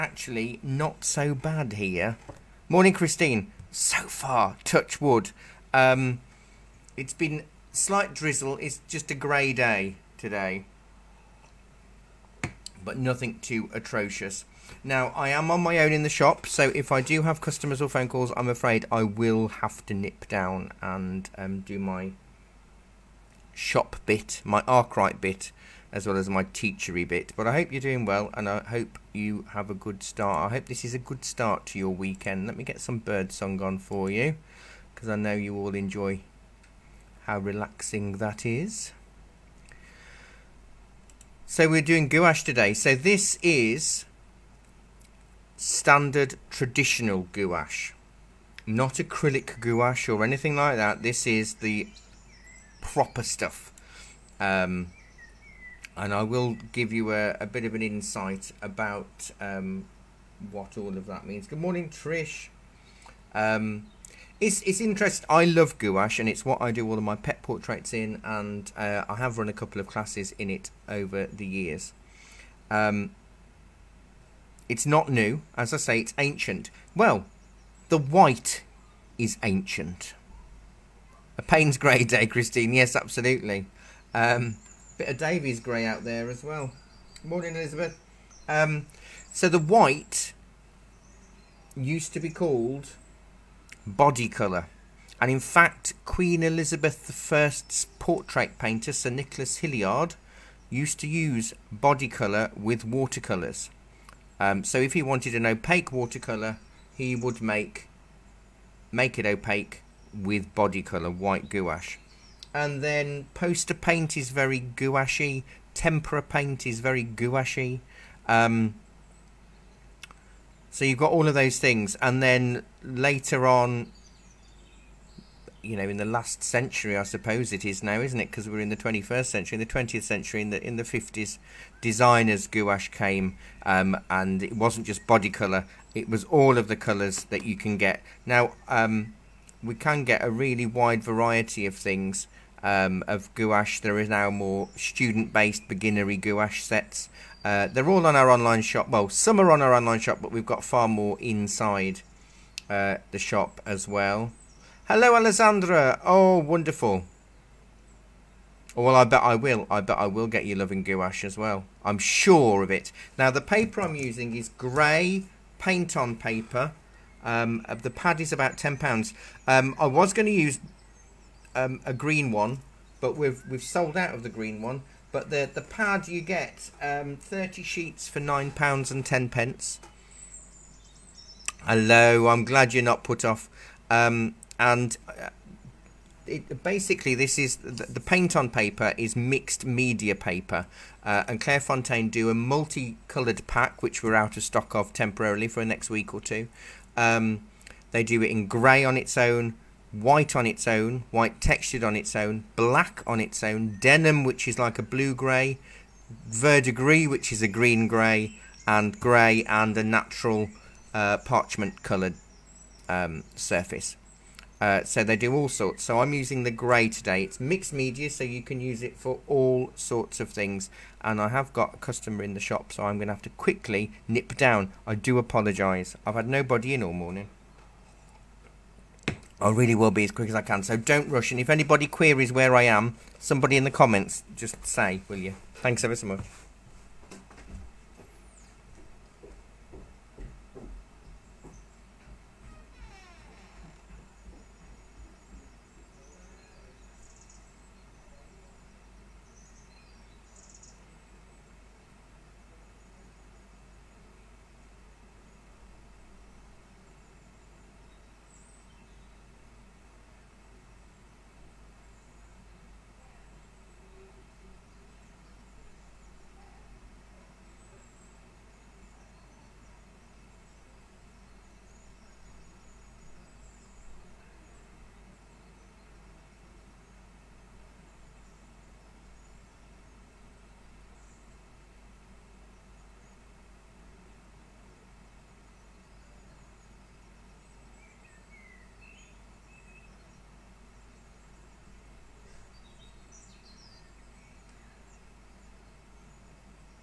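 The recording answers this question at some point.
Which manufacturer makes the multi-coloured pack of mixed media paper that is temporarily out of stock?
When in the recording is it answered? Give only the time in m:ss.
3:11.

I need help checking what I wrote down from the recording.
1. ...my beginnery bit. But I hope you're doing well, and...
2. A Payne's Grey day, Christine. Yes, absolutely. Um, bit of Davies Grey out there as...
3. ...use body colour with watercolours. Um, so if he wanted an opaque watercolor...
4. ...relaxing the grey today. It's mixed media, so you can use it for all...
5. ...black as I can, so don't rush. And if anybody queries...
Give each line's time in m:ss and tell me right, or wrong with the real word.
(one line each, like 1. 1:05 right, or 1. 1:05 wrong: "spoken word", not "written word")
1. 0:26 wrong: "teachery", not "beginnery"
2. 1:21 right
3. 1:41 right
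4. 3:36 wrong: "using", not "relaxing"
5. 3:50 wrong: "quick", not "black".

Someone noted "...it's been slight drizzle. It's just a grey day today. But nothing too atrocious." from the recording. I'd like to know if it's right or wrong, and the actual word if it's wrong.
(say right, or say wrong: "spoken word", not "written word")
right.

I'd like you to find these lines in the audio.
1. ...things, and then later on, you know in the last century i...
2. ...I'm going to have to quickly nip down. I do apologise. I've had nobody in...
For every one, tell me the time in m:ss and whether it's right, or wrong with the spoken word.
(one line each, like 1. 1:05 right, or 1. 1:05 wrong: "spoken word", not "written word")
1. 2:01 right
2. 3:42 right.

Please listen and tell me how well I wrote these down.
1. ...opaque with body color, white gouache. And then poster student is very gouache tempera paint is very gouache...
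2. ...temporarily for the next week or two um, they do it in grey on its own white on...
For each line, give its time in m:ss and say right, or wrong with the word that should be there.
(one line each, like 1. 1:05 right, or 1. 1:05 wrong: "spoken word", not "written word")
1. 1:49 wrong: "paint", not "student"
2. 3:14 right.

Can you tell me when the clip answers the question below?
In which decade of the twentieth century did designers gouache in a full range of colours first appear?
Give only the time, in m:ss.
2:10.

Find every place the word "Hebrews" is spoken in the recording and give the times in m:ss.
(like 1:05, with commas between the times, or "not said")
not said.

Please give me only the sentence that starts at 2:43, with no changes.
Now, the paper I'm using is grey paint-on paper.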